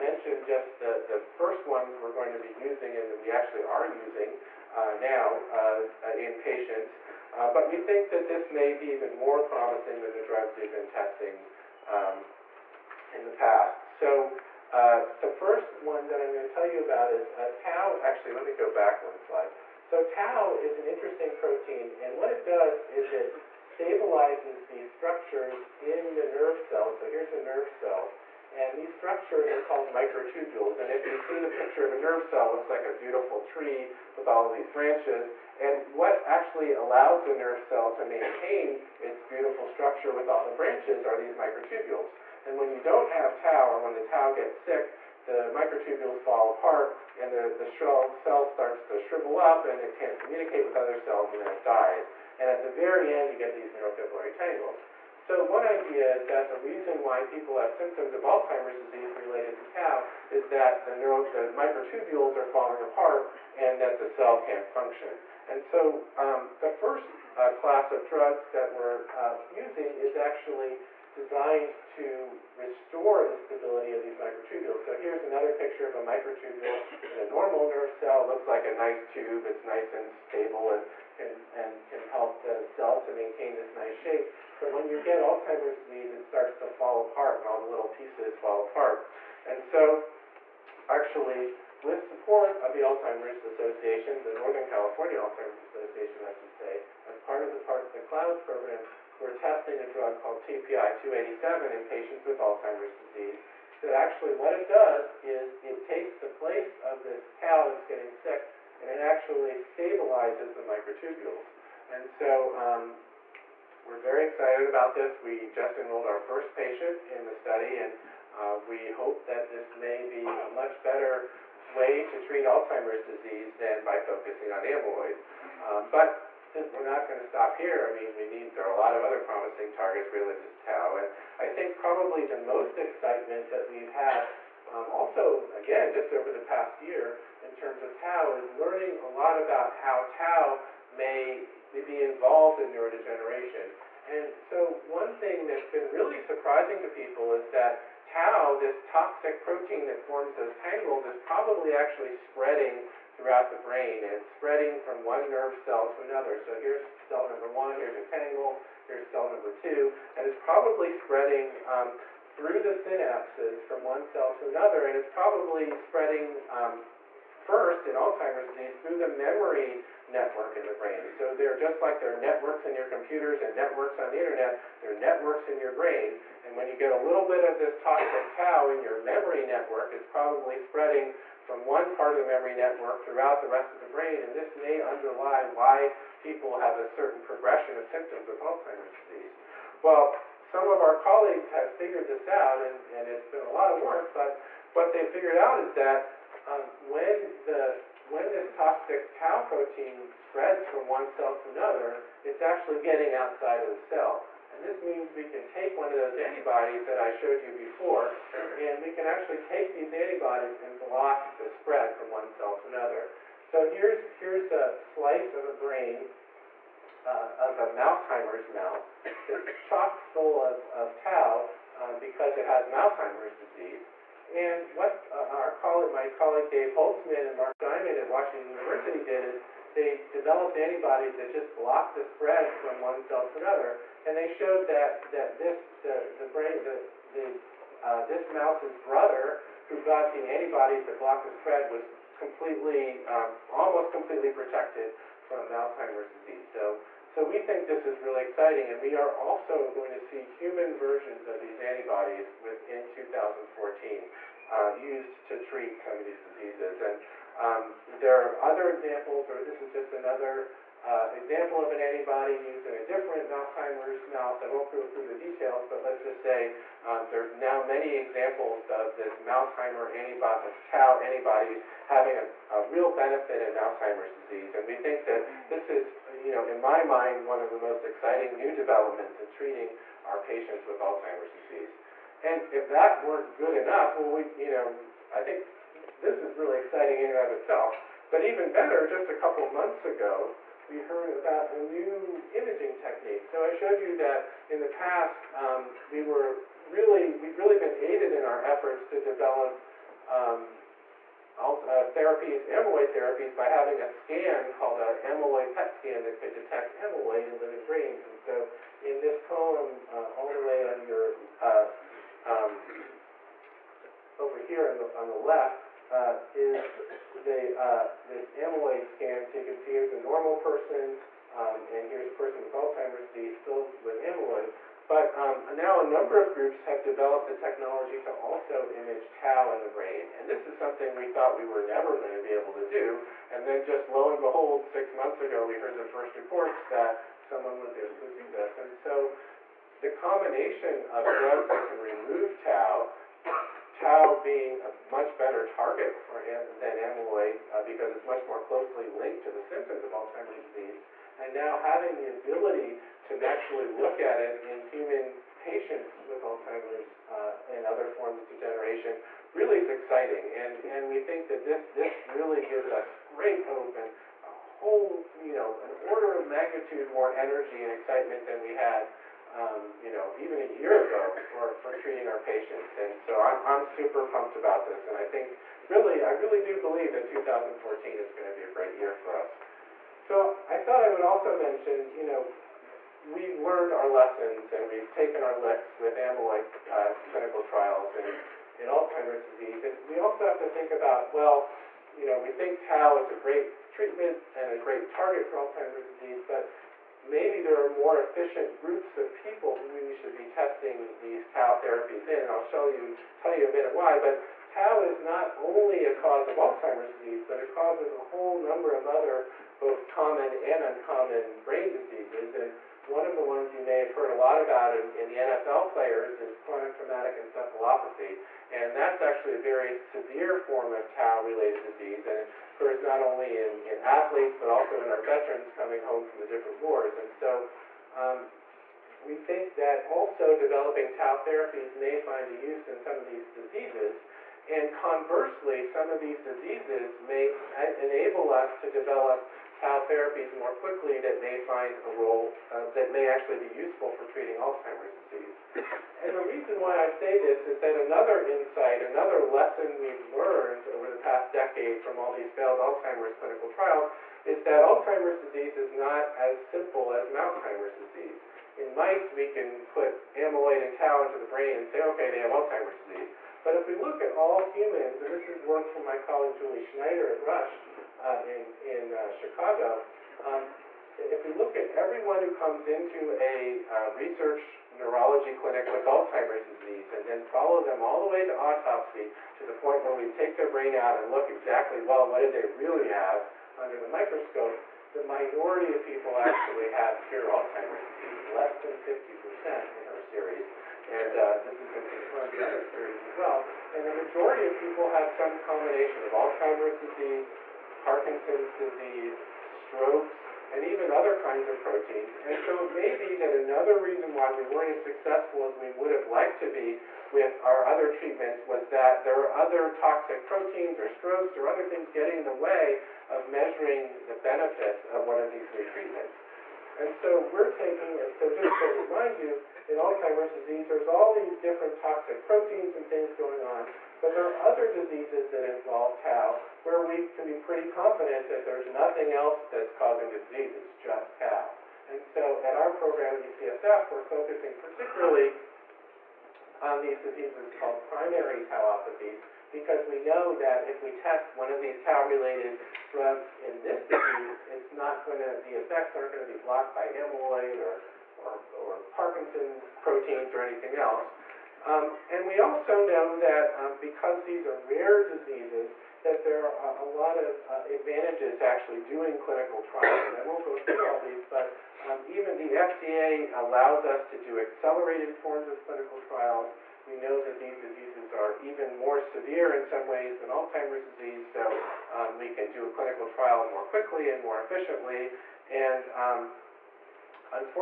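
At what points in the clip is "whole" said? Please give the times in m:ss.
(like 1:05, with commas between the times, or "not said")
6:04, 6:47.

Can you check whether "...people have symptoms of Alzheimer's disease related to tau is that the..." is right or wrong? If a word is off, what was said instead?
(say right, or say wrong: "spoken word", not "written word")
right.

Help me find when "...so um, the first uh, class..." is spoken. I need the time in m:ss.
1:05.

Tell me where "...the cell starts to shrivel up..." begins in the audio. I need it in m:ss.
0:47.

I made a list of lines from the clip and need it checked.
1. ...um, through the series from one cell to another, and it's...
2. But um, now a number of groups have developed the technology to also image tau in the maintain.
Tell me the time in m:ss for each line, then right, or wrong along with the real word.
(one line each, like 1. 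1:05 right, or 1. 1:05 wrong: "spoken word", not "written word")
1. 2:41 wrong: "synapses", not "series"
2. 5:24 wrong: "brain", not "maintain".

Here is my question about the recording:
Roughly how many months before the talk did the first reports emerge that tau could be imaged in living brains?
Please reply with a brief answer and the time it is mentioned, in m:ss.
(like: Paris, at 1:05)
6, at 5:34.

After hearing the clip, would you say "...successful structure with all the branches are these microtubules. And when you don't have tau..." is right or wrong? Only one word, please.
wrong.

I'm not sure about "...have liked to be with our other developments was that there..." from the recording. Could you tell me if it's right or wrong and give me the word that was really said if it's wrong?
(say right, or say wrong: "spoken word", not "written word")
wrong: "treatments", not "developments".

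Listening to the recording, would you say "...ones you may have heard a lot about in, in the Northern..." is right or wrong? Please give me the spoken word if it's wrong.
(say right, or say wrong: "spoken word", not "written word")
wrong: "NFL", not "Northern".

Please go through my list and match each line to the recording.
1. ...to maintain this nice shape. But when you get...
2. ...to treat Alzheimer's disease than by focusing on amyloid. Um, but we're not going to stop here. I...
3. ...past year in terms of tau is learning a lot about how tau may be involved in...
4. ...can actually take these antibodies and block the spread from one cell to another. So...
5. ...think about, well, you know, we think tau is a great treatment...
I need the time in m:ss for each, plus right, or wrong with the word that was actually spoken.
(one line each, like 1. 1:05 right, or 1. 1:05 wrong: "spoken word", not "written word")
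1. 1:22 right
2. 2:02 right
3. 2:16 right
4. 3:28 right
5. 6:30 right.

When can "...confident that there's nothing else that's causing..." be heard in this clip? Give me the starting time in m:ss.
8:47.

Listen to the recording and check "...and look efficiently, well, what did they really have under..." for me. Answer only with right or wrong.
wrong.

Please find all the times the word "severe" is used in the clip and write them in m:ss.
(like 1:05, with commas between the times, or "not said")
6:59, 9:28.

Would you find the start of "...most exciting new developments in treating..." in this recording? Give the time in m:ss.
4:37.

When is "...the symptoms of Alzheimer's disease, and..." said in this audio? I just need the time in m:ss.
5:49.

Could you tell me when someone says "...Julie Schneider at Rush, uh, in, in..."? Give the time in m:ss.
7:46.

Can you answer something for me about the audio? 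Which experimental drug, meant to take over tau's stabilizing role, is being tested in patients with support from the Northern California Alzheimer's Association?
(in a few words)
TPI-287.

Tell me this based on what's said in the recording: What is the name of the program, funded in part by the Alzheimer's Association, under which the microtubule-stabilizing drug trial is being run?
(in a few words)
CLOUD.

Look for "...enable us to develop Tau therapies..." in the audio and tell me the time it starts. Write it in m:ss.
7:17.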